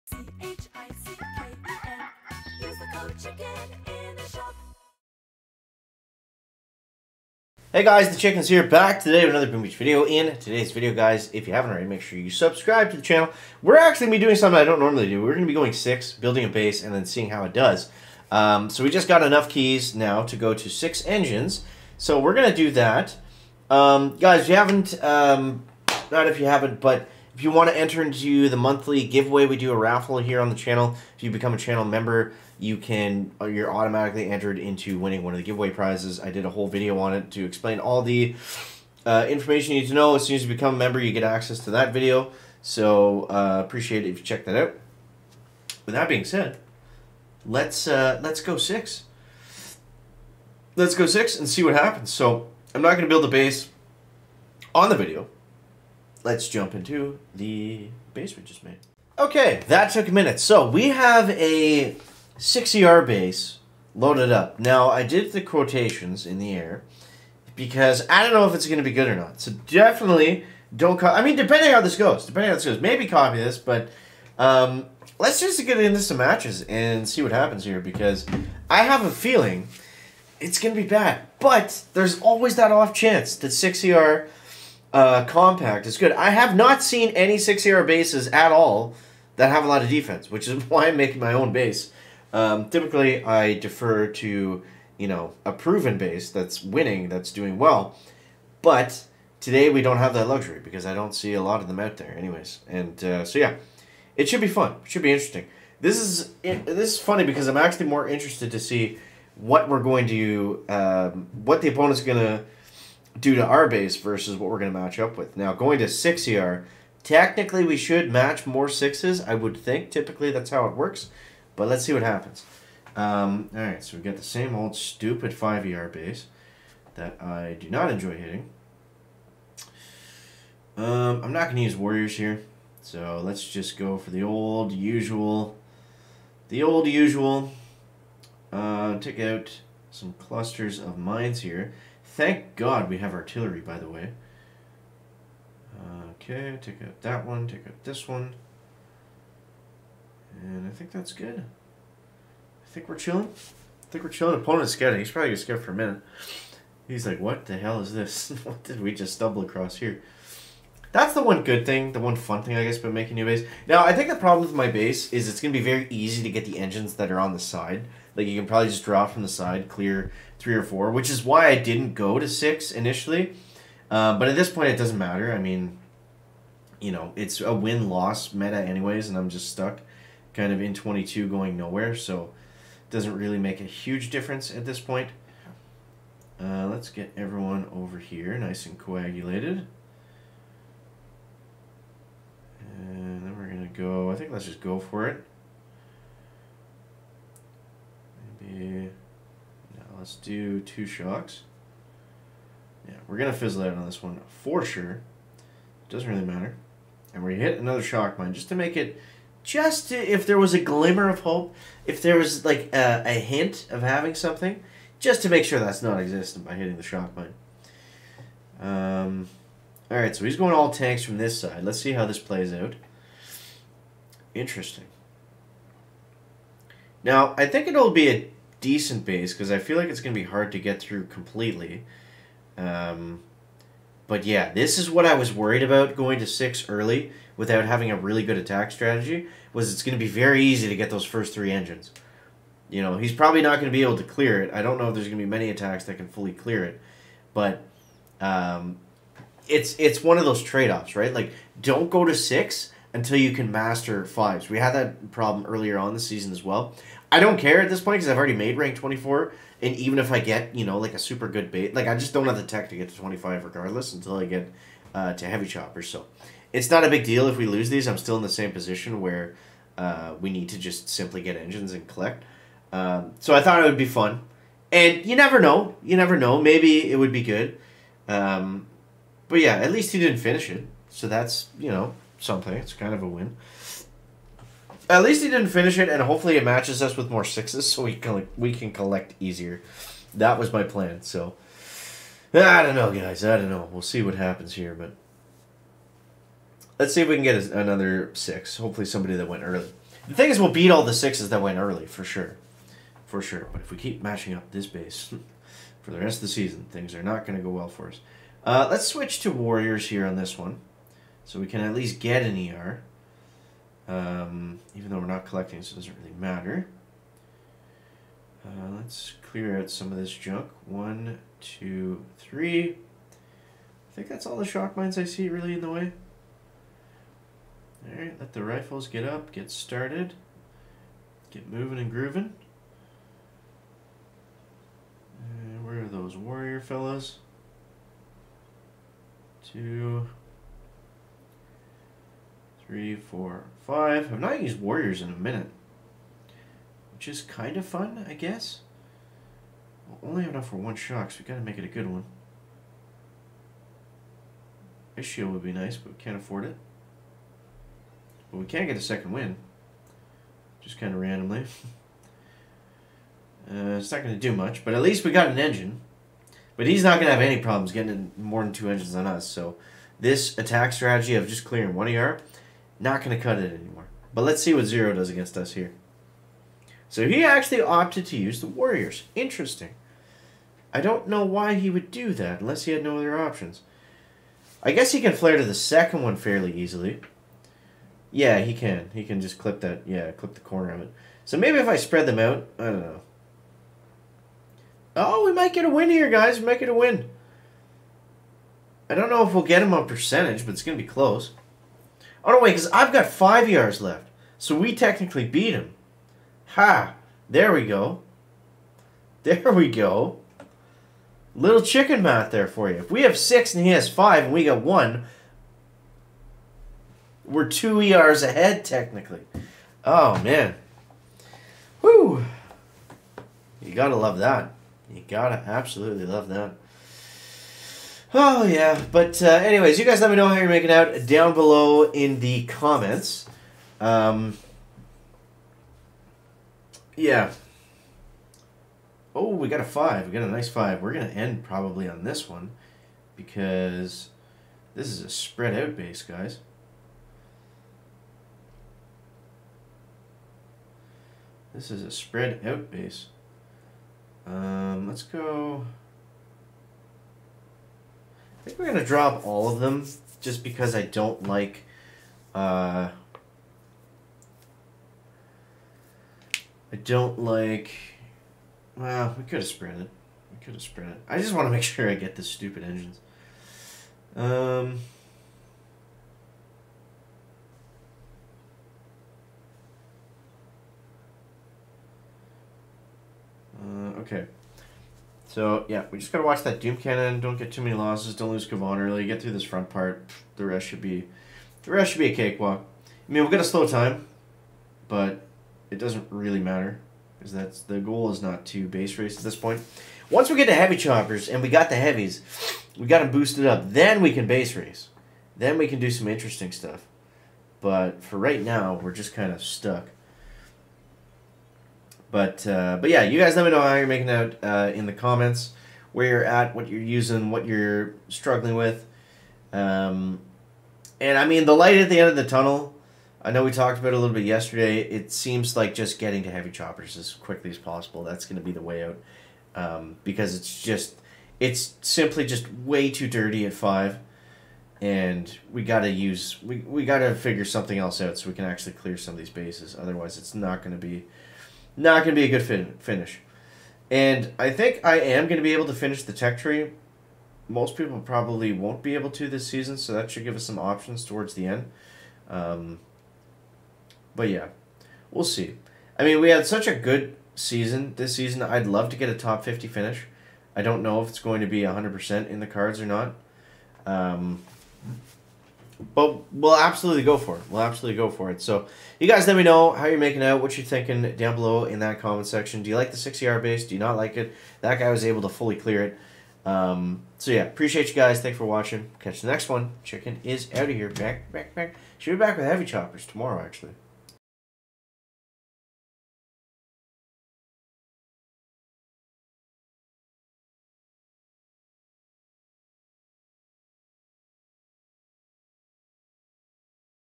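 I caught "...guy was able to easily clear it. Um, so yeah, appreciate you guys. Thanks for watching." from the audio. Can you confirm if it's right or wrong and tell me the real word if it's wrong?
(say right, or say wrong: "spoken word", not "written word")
wrong: "fully", not "easily".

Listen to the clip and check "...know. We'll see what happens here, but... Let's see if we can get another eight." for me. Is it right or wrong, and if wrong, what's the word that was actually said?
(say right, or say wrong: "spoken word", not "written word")
wrong: "six", not "eight".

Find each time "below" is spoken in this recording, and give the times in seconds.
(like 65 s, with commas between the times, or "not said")
431 s, 571 s.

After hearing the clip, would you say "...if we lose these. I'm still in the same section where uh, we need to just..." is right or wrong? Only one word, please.
wrong.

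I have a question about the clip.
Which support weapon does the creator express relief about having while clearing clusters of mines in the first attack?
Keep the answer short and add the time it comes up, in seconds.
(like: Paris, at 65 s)
Artillery, at 143 s.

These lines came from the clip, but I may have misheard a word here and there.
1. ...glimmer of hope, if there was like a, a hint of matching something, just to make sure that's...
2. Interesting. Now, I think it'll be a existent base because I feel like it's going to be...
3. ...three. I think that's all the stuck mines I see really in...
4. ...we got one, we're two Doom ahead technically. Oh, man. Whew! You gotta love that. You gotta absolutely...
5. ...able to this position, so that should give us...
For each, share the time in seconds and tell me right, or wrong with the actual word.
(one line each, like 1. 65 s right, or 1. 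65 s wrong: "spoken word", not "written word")
1. 210 s wrong: "having", not "matching"
2. 224 s wrong: "decent", not "existent"
3. 322 s wrong: "shock", not "stuck"
4. 414 s wrong: "ERs", not "Doom"
5. 548 s wrong: "season", not "position".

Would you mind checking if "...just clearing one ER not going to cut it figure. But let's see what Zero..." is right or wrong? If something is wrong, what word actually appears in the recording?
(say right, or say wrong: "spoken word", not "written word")
wrong: "anymore", not "figure".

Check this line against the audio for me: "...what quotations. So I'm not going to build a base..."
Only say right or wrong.
wrong.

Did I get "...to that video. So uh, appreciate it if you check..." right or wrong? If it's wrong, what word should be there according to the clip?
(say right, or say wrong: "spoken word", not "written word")
right.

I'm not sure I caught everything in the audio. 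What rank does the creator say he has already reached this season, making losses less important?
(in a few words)
24.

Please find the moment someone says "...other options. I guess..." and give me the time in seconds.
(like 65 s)
382 s.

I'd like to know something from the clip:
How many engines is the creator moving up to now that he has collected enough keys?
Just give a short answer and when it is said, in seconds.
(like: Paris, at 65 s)
6, at 20 s.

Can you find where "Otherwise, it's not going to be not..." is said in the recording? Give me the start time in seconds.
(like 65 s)
539 s.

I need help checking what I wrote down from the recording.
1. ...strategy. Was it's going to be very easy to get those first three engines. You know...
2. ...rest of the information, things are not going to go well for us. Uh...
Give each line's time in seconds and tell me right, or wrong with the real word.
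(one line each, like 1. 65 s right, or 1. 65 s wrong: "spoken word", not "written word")
1. 238 s right
2. 305 s wrong: "season", not "information".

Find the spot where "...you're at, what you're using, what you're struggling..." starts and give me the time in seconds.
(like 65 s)
516 s.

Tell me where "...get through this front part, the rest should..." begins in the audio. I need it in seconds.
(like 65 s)
489 s.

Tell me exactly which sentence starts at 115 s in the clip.
Now, going to 6 ER, technically we should match more 6s, I would think.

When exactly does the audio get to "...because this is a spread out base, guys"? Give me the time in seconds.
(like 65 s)
443 s.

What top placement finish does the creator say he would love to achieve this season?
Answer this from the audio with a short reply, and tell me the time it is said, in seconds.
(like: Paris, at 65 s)
Top 50, at 559 s.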